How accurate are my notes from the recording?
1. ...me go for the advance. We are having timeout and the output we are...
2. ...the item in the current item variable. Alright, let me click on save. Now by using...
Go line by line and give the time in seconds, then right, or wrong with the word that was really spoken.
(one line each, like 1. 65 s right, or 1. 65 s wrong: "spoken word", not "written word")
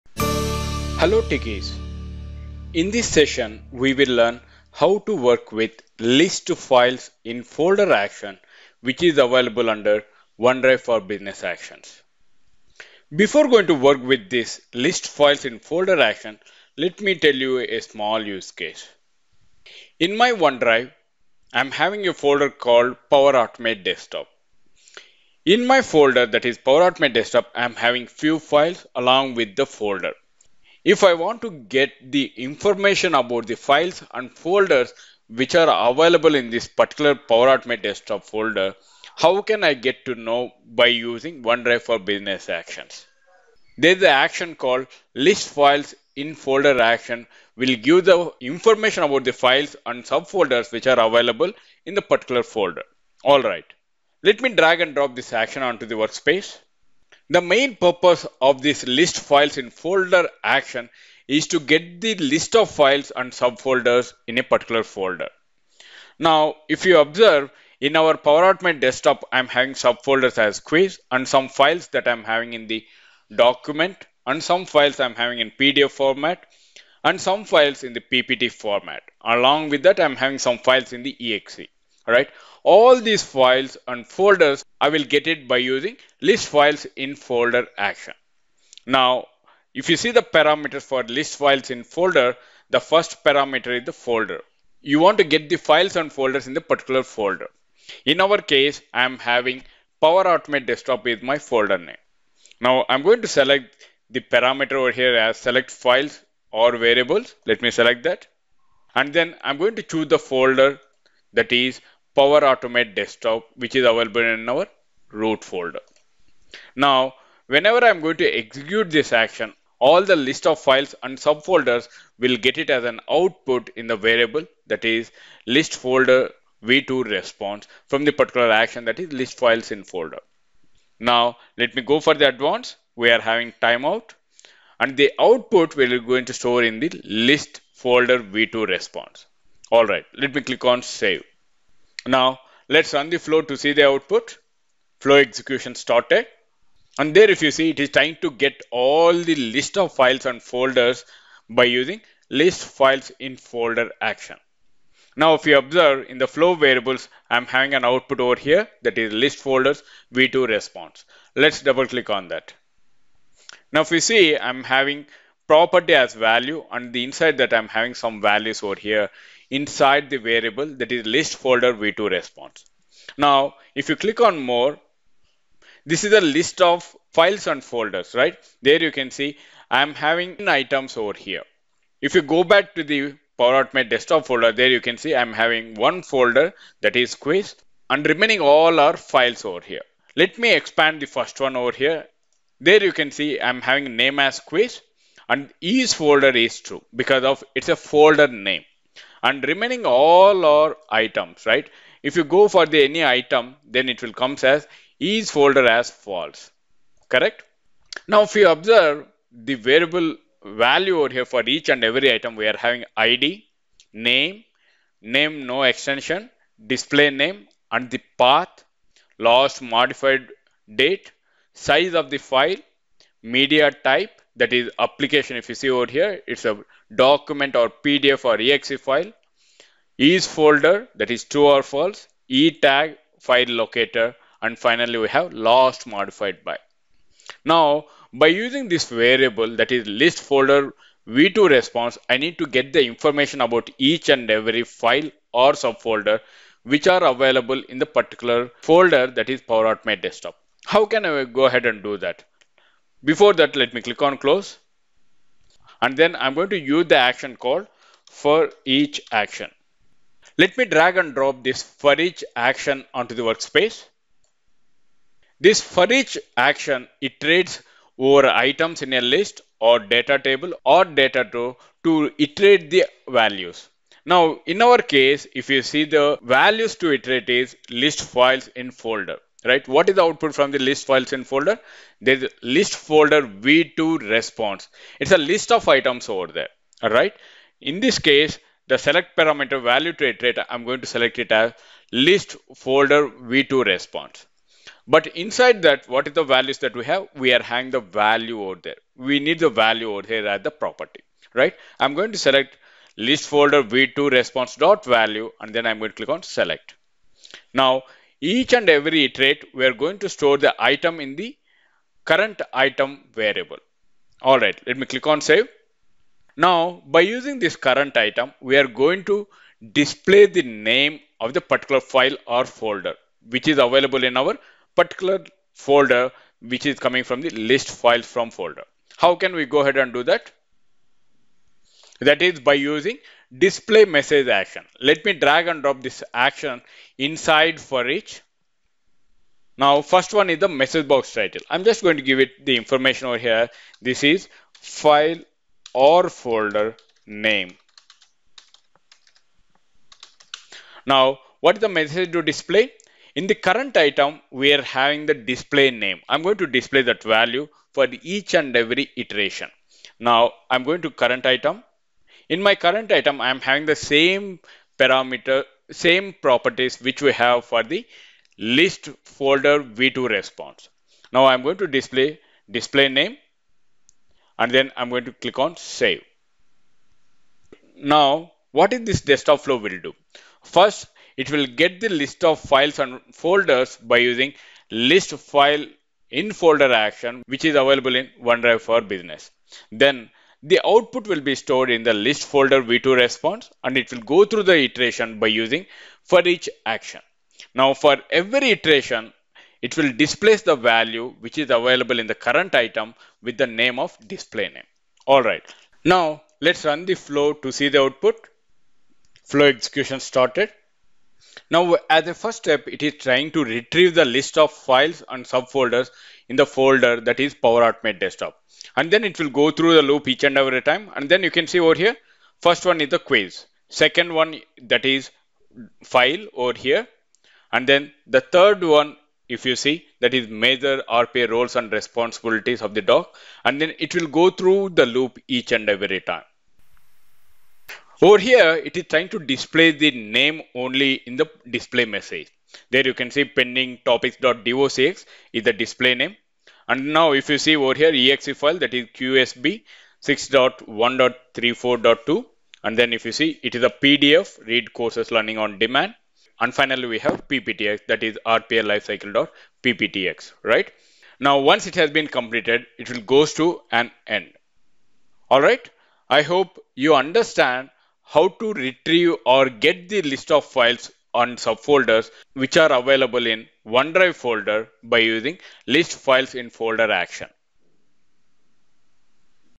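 1. 131 s right
2. 310 s right.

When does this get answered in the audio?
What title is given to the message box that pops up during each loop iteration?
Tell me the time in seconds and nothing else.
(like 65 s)
343 s.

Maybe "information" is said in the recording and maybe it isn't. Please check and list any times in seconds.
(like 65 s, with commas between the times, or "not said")
32 s, 48 s, 242 s, 342 s.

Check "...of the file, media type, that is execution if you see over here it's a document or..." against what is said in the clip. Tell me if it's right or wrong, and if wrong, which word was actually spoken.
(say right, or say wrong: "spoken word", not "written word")
wrong: "application", not "execution".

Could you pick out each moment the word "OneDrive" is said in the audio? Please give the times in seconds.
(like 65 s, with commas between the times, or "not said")
10 s, 20 s, 41 s, 388 s, 473 s.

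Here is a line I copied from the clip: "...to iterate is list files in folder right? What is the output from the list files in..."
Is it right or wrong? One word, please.
right.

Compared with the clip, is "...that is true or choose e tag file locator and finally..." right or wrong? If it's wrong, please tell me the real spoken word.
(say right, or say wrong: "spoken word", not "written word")
wrong: "false", not "choose".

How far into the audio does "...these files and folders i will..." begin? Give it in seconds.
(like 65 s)
83 s.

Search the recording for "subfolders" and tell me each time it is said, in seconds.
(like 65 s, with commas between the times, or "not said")
50 s, 63 s, 69 s, 121 s, 245 s, 415 s, 471 s.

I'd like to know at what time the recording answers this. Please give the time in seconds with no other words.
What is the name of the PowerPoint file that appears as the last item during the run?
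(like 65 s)
458 s.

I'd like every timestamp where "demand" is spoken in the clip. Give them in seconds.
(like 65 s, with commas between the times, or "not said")
455 s.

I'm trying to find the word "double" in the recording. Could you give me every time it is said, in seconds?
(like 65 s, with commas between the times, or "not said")
161 s.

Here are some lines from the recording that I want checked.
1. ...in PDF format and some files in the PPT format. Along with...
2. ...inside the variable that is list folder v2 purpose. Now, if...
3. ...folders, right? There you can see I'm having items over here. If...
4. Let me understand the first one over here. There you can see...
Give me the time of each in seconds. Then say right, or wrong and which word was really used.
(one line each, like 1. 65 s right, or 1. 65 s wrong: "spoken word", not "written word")
1. 75 s right
2. 169 s wrong: "response", not "purpose"
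3. 177 s right
4. 190 s wrong: "expand", not "understand".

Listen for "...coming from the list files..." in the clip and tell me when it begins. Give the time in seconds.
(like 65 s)
326 s.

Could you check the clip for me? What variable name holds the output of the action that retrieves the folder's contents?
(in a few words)
list folder v2 response.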